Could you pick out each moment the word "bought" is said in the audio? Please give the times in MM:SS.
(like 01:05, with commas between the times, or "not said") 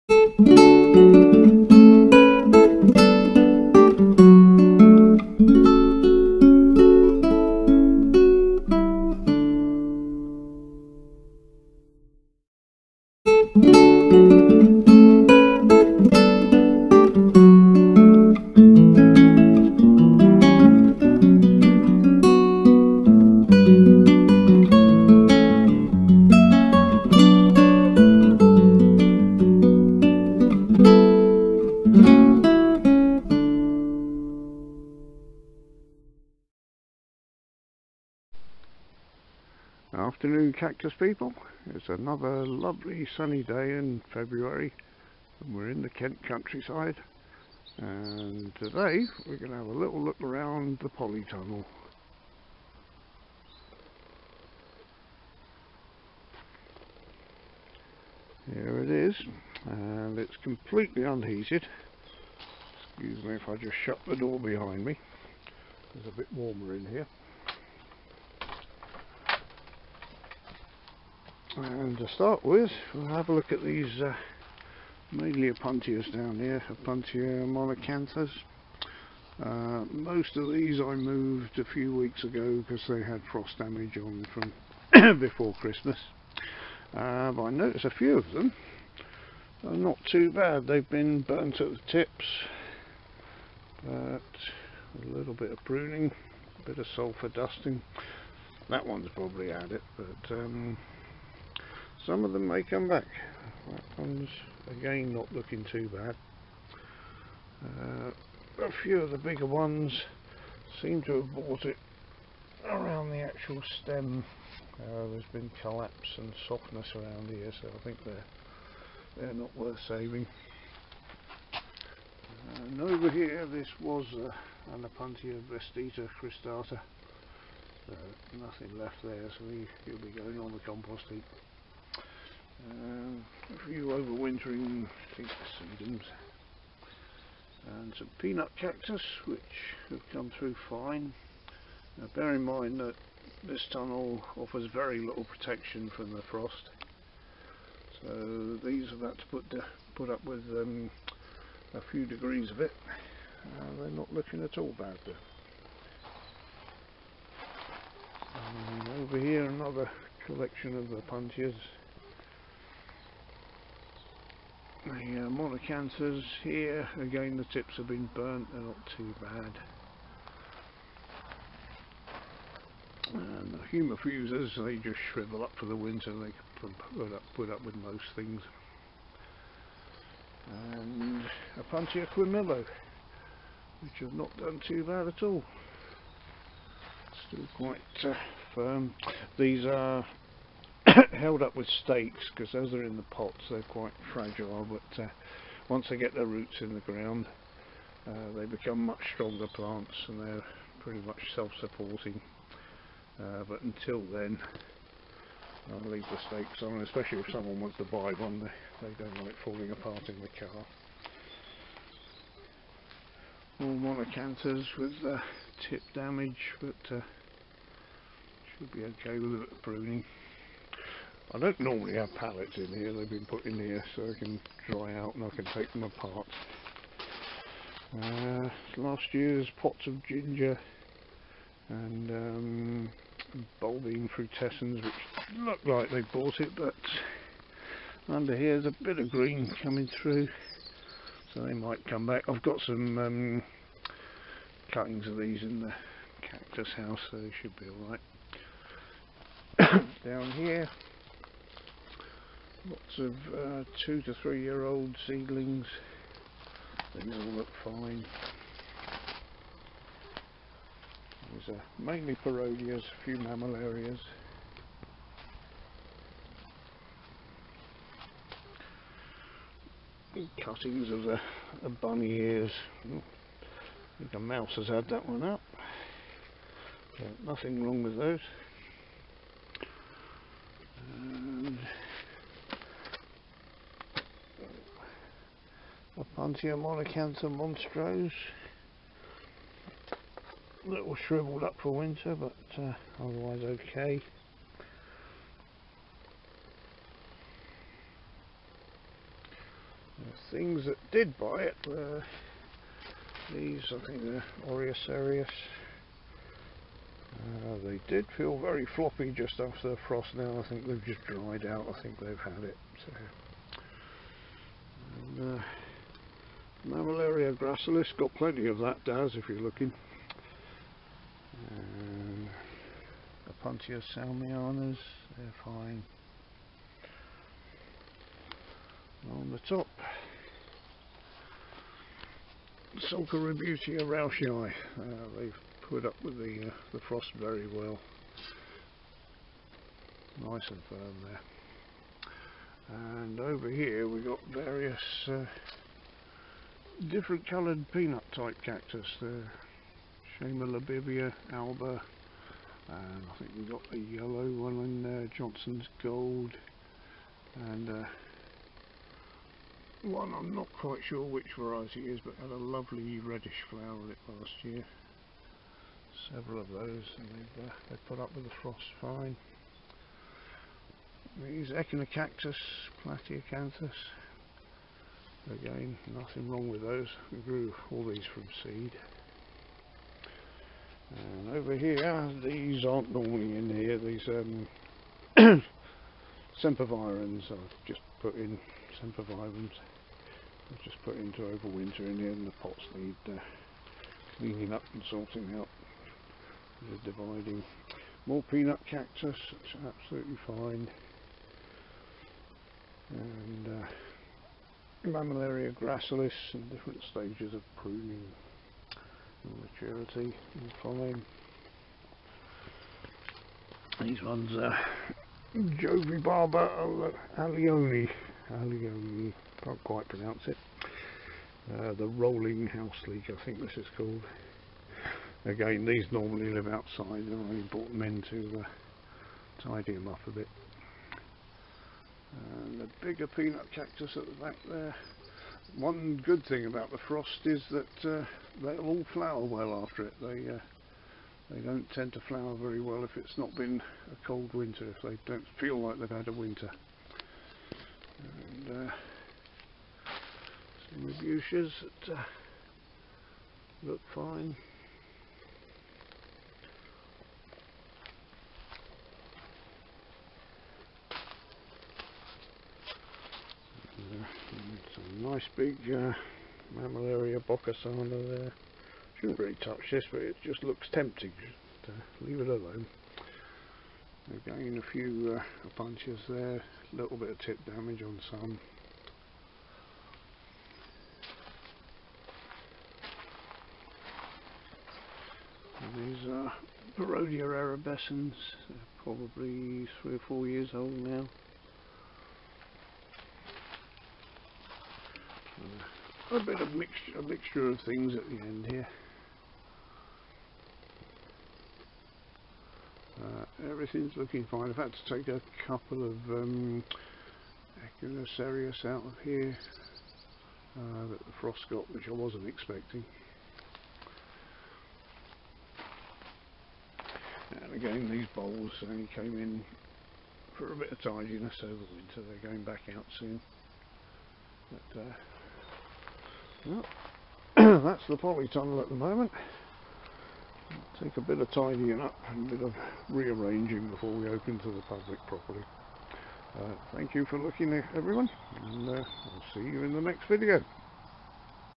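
01:51, 03:56.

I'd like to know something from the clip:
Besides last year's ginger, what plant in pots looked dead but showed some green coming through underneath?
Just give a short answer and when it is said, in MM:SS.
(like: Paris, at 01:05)
Bulbine frutescens, at 03:53.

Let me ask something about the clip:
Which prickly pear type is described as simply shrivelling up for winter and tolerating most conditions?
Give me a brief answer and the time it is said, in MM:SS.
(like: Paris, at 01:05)
Humifusas, at 02:53.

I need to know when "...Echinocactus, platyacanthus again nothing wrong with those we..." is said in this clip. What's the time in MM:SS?
06:11.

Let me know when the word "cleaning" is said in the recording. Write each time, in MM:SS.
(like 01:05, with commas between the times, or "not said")
06:34.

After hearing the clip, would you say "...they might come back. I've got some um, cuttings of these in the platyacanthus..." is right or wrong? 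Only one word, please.
wrong.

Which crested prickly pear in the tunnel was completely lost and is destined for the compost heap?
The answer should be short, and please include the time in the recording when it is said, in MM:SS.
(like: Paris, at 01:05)
Opuntia vestita cristata, at 02:04.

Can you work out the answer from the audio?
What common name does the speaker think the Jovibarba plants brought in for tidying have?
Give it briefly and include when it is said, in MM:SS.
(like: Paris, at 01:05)
Rolling house leek, at 07:01.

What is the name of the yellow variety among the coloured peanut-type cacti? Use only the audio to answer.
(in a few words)
Johnson's gold.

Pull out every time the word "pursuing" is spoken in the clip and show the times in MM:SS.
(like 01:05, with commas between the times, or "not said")
not said.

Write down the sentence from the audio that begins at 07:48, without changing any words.
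Shouldn't really touch this, but it just looks tempting.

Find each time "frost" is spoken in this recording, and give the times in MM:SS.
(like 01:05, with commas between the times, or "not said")
01:23, 02:26, 05:09, 05:36, 06:08, 07:16, 08:31.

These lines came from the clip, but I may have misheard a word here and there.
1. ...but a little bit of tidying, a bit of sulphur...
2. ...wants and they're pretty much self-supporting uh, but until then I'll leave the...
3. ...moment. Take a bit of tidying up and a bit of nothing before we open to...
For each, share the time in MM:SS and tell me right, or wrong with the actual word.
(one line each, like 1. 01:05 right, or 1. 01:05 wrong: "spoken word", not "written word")
1. 01:33 wrong: "pruning", not "tidying"
2. 03:19 wrong: "plants", not "wants"
3. 08:48 wrong: "rearranging", not "nothing".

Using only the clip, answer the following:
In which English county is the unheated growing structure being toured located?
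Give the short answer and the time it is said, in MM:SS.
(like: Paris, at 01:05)
Kent, at 00:45.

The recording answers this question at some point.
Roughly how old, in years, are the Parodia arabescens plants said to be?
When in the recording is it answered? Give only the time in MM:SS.
08:09.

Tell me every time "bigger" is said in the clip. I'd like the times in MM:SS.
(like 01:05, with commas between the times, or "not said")
01:49, 07:12.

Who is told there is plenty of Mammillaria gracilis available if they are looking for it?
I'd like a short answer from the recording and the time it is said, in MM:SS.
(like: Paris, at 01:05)
Daz, at 05:18.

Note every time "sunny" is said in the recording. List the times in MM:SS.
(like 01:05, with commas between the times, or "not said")
00:43.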